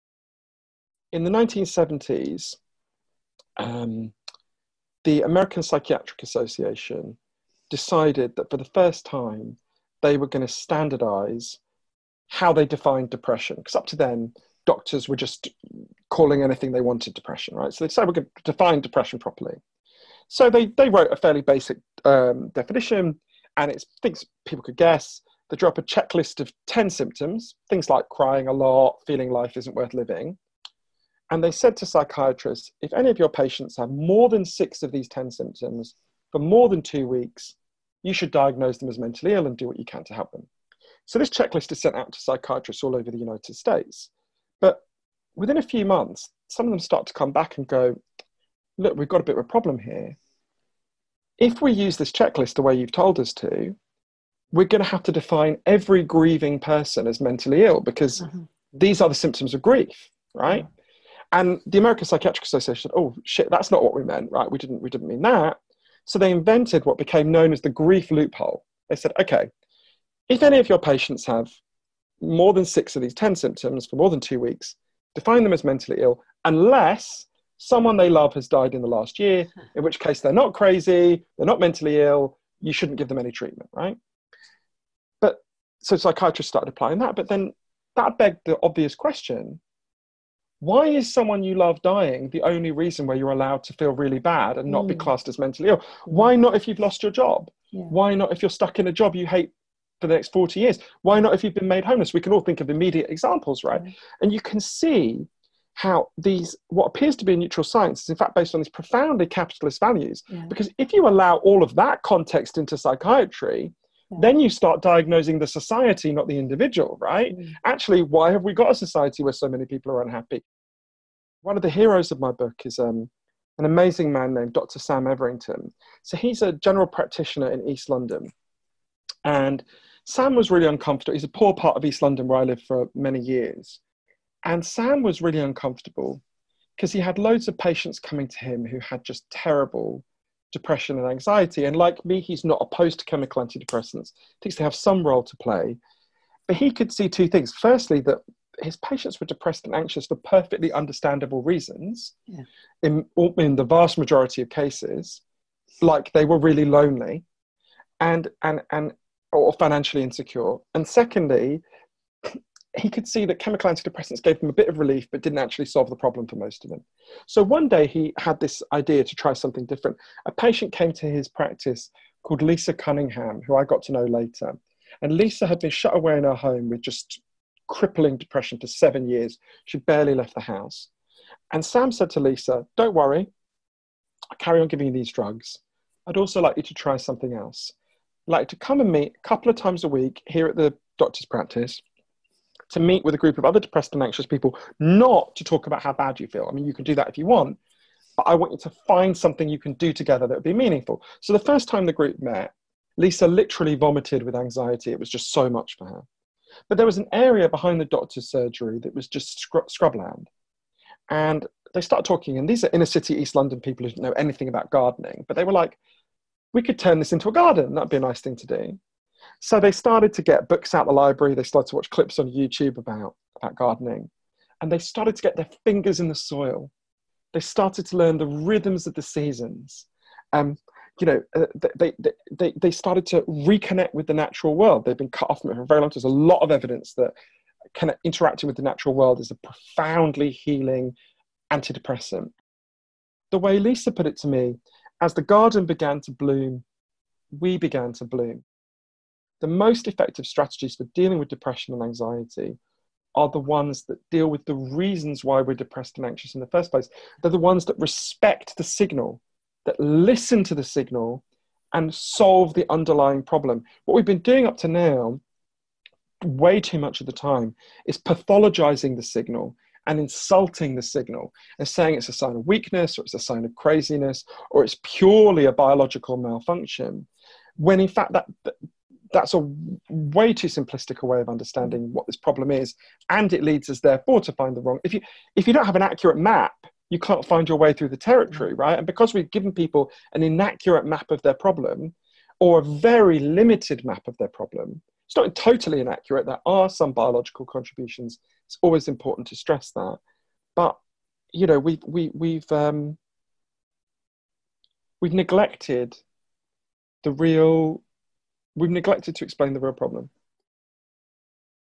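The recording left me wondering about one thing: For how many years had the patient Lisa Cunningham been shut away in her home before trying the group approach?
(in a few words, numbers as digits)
7.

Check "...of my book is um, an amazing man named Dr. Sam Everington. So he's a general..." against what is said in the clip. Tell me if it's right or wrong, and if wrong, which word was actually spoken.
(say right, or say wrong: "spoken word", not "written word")
right.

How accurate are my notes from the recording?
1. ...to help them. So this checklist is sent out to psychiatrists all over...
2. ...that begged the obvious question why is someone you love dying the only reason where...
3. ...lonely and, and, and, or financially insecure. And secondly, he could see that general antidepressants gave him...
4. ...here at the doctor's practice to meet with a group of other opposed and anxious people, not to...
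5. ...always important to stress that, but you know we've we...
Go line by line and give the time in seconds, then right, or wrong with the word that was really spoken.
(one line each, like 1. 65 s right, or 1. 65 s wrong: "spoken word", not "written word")
1. 40 s right
2. 87 s right
3. 156 s wrong: "chemical", not "general"
4. 190 s wrong: "depressed", not "opposed"
5. 298 s right.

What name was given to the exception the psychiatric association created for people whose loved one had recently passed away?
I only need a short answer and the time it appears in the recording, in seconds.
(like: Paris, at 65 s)
the grief loophole, at 67 s.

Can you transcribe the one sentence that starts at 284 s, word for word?
If you if you don't have an accurate map, you can't find your way through the territory, right?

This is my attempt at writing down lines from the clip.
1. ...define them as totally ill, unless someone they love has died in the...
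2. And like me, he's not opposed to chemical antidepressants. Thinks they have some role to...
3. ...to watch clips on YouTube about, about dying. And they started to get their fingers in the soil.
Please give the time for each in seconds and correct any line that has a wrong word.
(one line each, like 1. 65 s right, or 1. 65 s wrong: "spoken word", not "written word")
1. 75 s wrong: "mentally", not "totally"
2. 141 s right
3. 221 s wrong: "gardening", not "dying".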